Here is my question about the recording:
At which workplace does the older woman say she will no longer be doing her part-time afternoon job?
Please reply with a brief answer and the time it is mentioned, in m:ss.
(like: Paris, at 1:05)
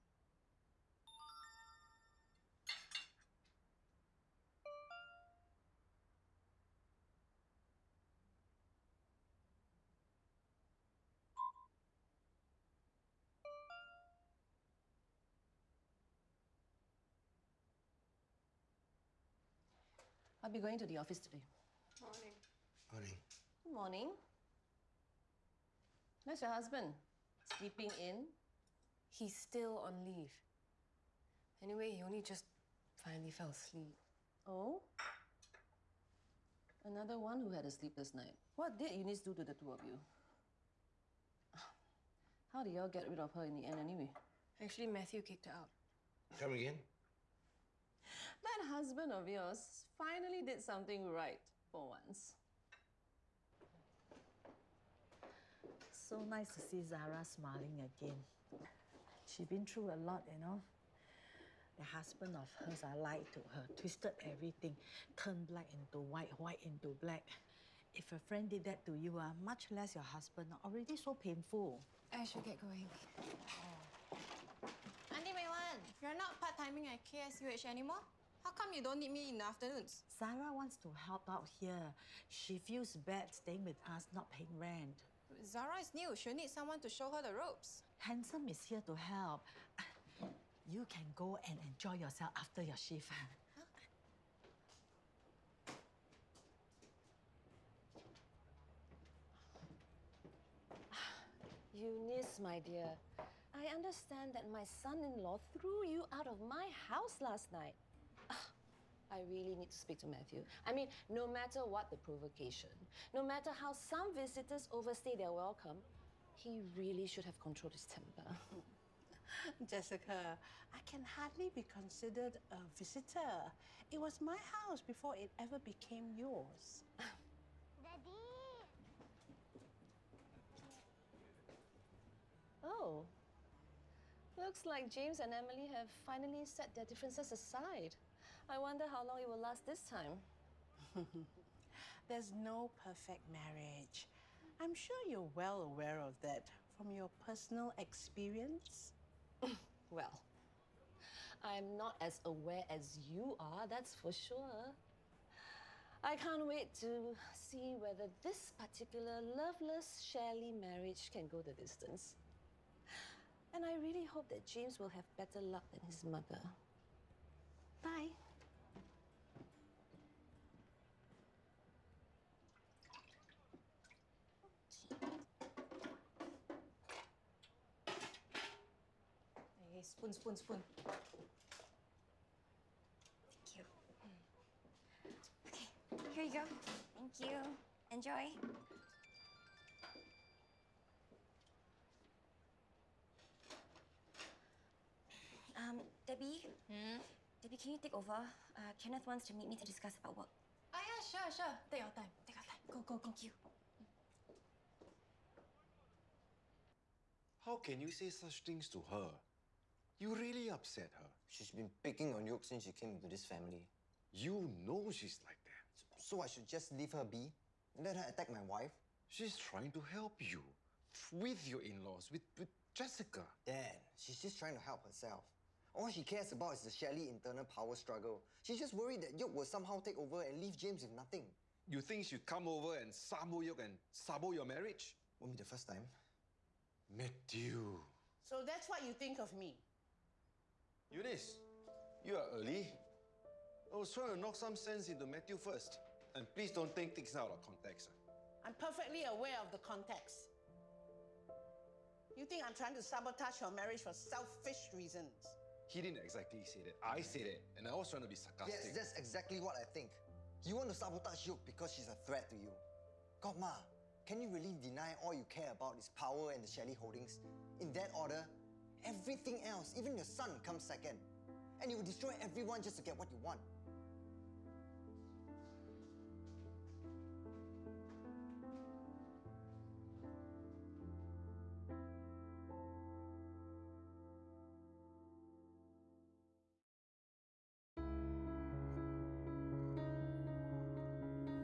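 KSUH, at 1:17.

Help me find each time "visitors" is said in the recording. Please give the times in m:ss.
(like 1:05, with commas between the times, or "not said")
1:54, 2:02.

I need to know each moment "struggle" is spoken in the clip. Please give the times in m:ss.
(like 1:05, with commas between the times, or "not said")
3:47.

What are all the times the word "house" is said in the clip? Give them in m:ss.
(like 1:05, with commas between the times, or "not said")
1:46, 2:04.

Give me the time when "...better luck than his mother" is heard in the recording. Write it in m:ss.
2:45.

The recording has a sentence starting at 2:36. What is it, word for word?
I can't wait to see whether this particular loveless shelly marriage can go the distance.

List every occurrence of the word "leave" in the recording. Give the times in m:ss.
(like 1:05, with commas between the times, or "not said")
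0:30, 3:36, 3:50.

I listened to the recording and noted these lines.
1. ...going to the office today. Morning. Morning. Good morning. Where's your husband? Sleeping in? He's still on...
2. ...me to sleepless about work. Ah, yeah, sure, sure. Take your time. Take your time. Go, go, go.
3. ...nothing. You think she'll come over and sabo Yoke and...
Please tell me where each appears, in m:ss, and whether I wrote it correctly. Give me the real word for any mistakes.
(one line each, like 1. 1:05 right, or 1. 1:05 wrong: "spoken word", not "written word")
1. 0:20 right
2. 3:19 wrong: "discuss", not "sleepless"
3. 3:50 right.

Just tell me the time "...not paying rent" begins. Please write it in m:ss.
1:24.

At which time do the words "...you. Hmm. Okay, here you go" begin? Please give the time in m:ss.
3:03.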